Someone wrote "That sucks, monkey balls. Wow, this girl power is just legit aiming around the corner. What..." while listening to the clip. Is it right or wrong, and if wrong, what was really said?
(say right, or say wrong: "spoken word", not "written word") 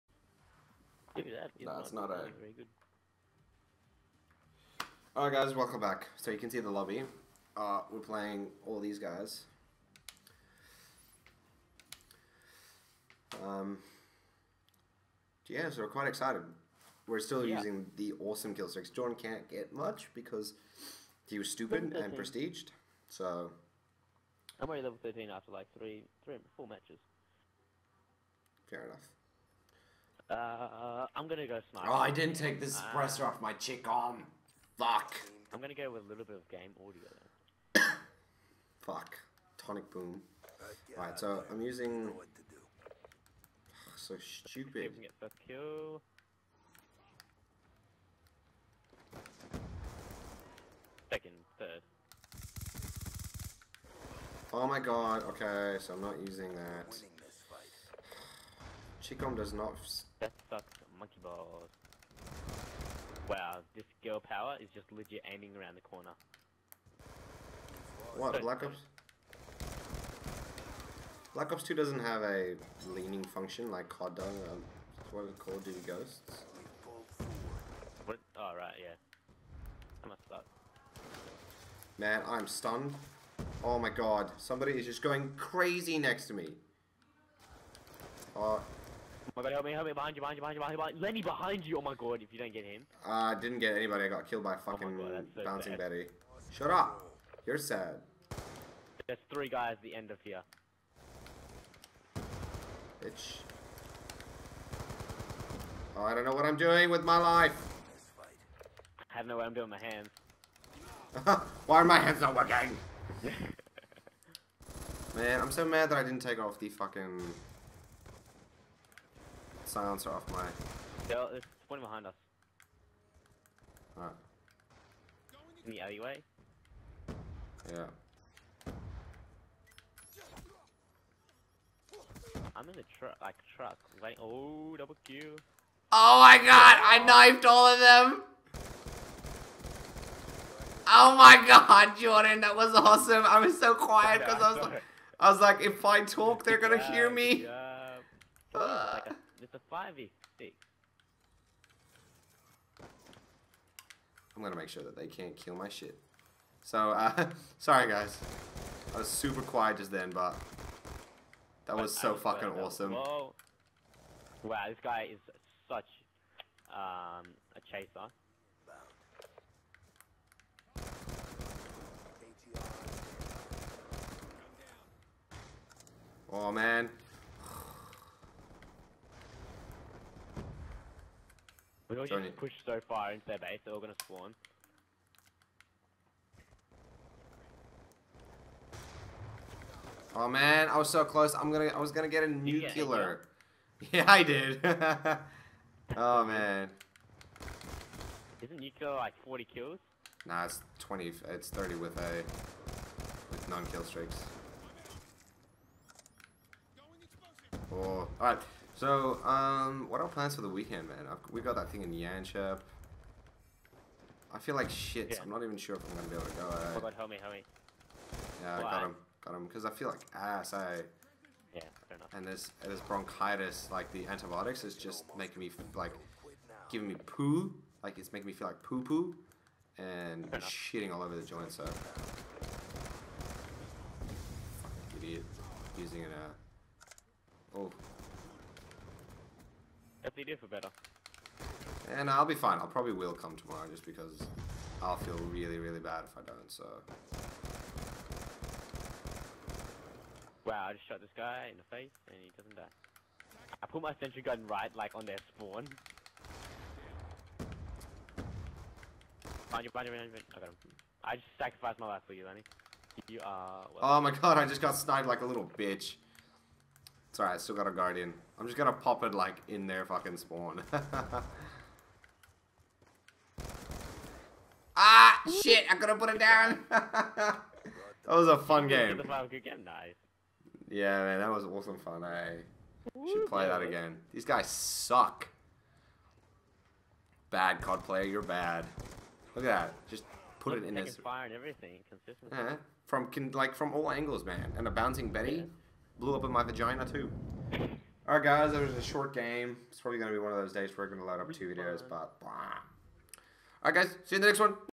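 right.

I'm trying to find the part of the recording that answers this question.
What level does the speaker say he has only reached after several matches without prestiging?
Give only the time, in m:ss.
0:24.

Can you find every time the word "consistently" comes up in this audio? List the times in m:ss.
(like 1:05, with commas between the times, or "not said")
4:51.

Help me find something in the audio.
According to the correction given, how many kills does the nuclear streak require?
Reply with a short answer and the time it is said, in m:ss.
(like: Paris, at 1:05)
20, at 3:20.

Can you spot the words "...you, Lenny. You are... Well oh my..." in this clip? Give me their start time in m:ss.
4:22.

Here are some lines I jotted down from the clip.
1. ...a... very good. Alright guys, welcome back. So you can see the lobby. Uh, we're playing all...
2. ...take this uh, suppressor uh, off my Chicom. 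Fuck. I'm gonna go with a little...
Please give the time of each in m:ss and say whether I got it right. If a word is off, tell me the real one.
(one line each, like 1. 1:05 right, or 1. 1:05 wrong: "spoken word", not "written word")
1. 0:02 right
2. 0:32 right.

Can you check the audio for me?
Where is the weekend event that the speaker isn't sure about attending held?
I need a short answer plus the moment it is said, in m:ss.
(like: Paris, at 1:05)
Yanchep, at 3:31.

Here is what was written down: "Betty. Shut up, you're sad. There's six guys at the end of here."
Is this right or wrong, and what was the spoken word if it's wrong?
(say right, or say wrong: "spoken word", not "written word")
wrong: "three", not "six".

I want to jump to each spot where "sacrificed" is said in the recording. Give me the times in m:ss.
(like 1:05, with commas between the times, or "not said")
4:21.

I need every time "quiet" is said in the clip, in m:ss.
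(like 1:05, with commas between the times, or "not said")
2:23, 2:39.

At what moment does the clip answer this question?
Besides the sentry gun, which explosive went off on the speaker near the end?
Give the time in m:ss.
4:54.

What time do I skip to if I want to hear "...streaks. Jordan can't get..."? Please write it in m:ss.
0:18.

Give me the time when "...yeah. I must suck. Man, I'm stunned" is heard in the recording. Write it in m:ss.
1:18.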